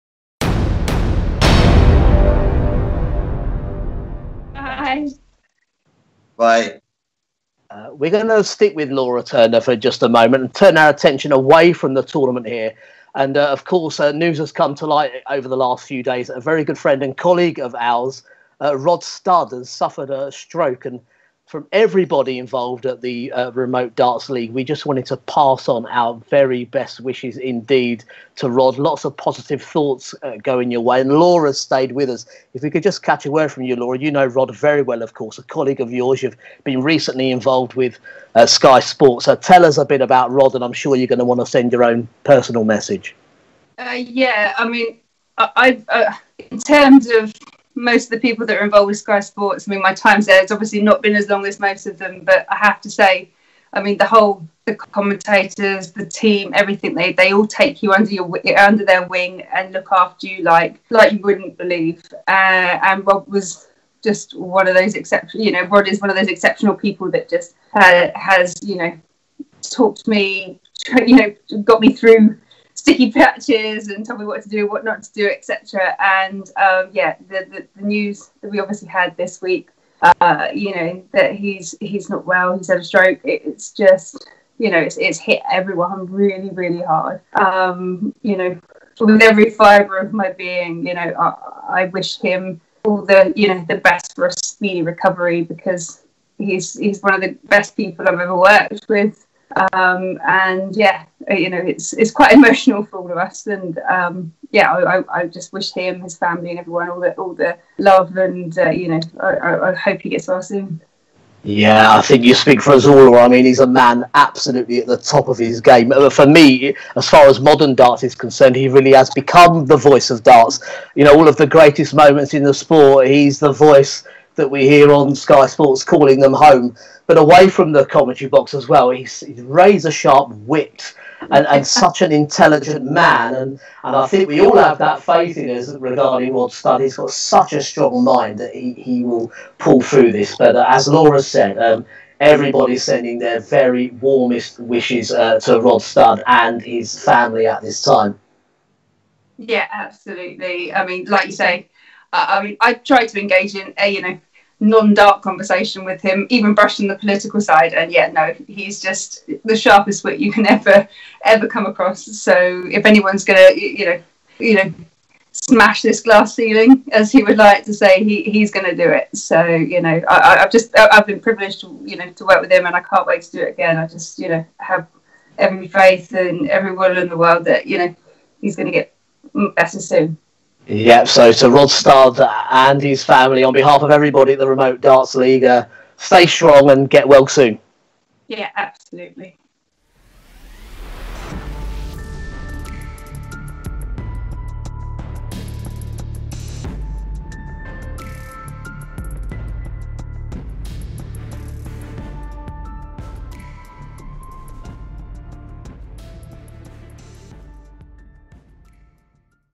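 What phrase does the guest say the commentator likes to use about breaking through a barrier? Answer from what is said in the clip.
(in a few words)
smash this glass ceiling.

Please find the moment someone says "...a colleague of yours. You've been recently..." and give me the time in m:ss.
0:35.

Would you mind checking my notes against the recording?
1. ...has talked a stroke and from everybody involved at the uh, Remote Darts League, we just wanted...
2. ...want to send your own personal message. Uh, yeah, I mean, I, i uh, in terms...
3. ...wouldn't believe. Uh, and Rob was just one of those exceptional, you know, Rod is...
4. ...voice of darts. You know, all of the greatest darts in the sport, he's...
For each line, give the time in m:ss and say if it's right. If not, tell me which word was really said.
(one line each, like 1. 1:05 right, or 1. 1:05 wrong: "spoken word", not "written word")
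1. 0:19 wrong: "suffered", not "talked"
2. 0:41 right
3. 1:01 right
4. 1:59 wrong: "moments", not "darts".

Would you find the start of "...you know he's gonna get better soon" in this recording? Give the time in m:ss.
2:57.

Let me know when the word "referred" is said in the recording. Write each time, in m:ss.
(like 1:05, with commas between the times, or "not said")
not said.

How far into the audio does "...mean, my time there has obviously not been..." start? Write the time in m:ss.
0:49.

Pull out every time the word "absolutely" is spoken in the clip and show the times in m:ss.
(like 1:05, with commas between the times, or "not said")
1:54, 2:29, 3:08.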